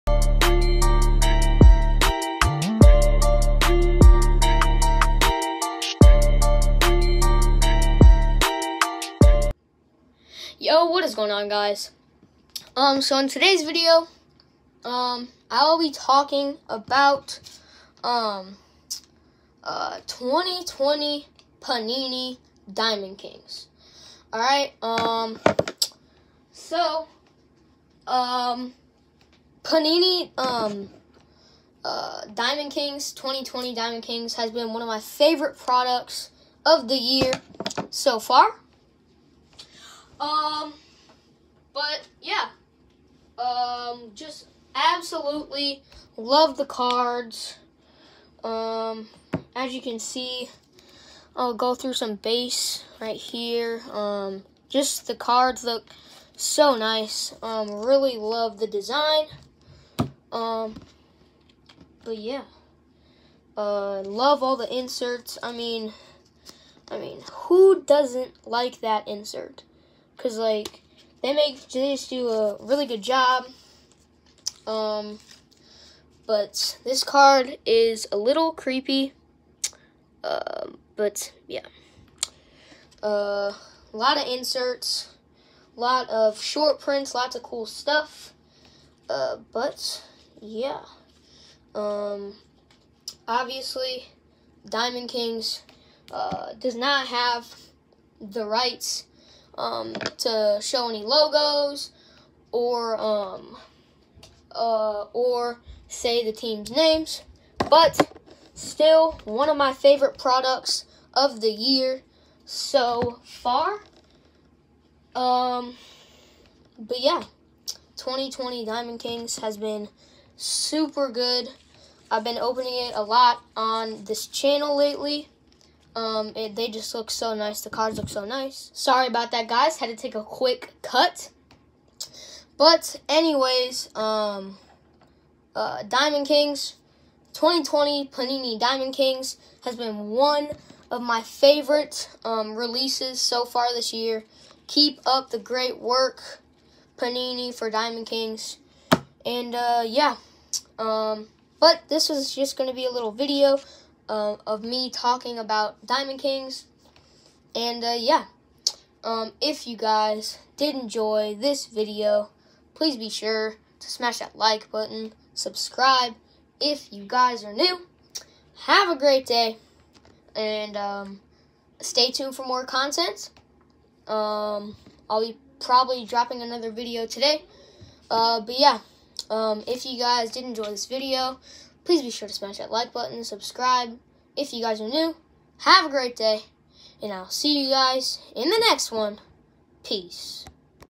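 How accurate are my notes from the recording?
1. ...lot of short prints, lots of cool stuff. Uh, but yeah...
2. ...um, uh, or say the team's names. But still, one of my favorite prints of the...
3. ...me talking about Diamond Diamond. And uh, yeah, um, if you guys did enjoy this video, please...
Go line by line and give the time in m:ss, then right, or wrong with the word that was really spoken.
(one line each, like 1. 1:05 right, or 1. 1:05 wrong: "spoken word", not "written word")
1. 1:25 right
2. 1:42 wrong: "products", not "prints"
3. 2:34 wrong: "Kings", not "Diamond".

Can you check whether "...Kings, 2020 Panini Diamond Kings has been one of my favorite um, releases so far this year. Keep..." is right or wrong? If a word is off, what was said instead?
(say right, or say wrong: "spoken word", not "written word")
right.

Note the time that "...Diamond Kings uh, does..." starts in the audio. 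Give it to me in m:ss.
1:34.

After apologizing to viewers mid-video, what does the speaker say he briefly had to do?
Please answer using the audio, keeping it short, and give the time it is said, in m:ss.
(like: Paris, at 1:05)
a quick cut, at 2:10.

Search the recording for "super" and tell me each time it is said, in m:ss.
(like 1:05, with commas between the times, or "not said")
2:00.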